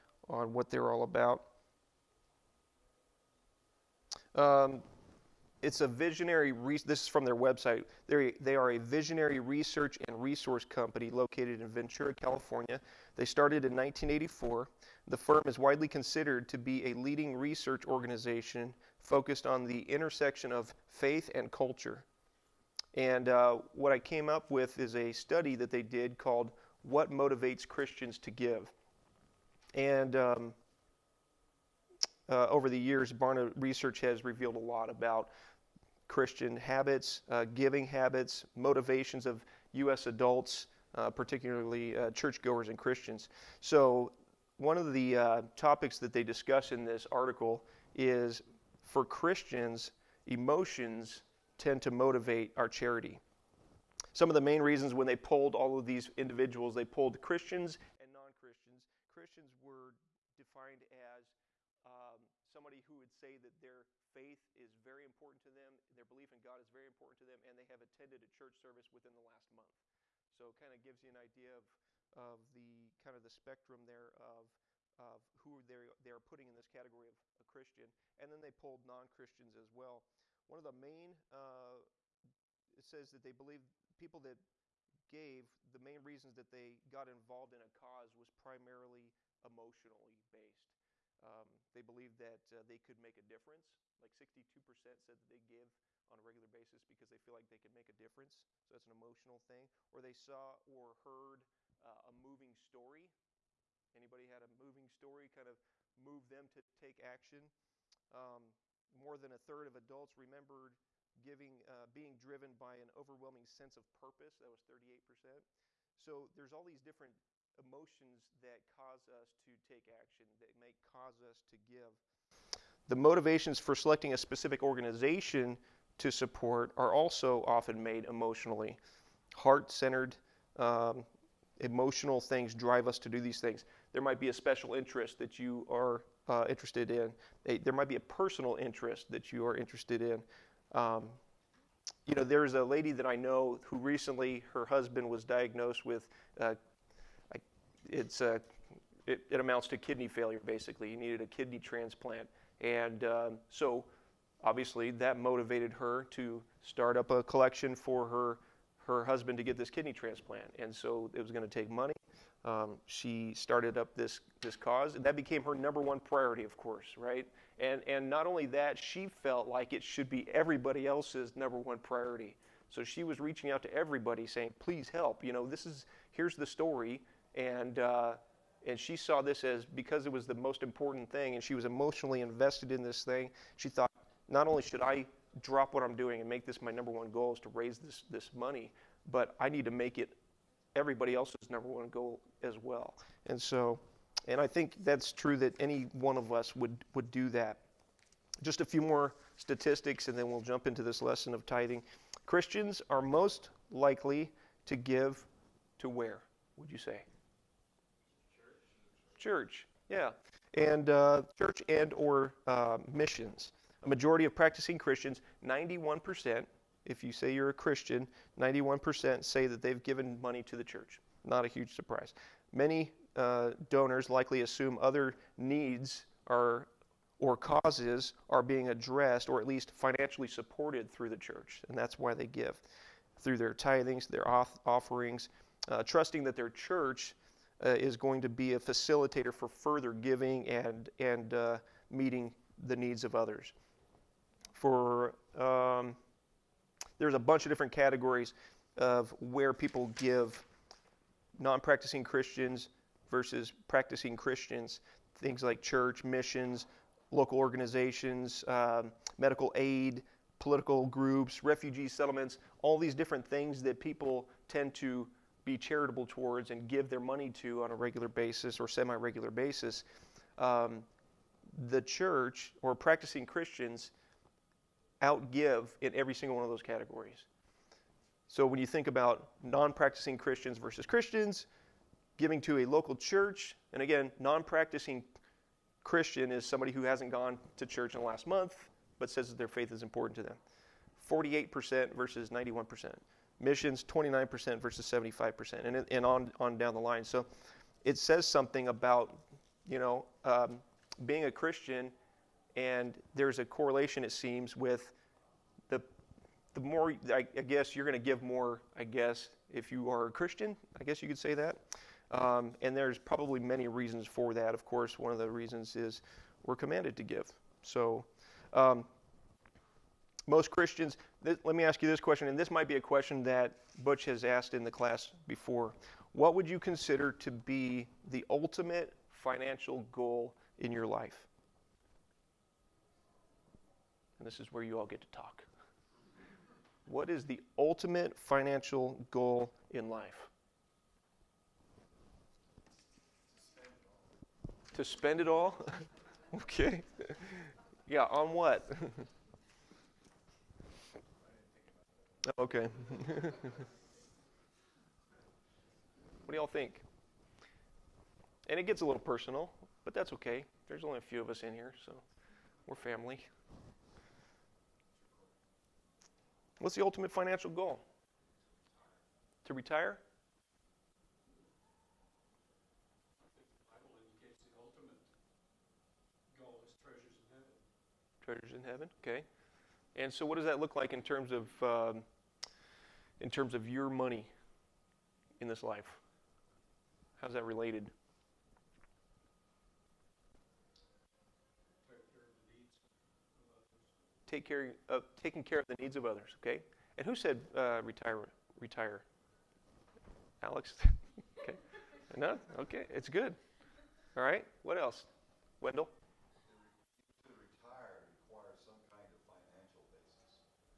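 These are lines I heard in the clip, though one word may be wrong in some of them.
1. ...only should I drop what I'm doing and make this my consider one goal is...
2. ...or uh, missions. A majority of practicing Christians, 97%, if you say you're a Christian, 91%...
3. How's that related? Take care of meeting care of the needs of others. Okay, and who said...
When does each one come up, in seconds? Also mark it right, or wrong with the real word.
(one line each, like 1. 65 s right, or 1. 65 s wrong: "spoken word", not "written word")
1. 184 s wrong: "number", not "consider"
2. 211 s wrong: "91", not "97"
3. 387 s wrong: "taking", not "meeting".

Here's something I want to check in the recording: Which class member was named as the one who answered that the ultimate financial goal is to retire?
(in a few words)
Alex.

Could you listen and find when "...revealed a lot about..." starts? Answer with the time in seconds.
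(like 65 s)
34 s.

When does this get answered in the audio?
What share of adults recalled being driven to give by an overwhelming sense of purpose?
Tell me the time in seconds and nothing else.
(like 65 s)
114 s.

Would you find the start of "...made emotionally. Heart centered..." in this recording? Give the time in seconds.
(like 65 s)
127 s.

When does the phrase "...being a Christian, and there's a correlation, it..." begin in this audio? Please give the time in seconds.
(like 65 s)
301 s.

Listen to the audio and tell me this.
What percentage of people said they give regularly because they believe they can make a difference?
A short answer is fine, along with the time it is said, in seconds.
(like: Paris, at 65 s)
62%, at 94 s.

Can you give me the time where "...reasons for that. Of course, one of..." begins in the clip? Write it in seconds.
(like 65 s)
313 s.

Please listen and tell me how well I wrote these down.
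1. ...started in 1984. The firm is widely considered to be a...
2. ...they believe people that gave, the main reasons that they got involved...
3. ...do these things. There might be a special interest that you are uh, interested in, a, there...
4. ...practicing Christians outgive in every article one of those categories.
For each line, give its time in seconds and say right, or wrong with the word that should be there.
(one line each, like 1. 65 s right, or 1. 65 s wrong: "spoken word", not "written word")
1. 13 s right
2. 83 s right
3. 133 s right
4. 272 s wrong: "single", not "article".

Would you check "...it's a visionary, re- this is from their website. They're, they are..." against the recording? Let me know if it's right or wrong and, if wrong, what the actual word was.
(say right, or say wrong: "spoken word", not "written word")
right.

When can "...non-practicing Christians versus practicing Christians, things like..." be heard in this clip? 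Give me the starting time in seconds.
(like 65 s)
251 s.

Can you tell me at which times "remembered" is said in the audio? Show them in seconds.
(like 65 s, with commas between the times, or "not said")
110 s.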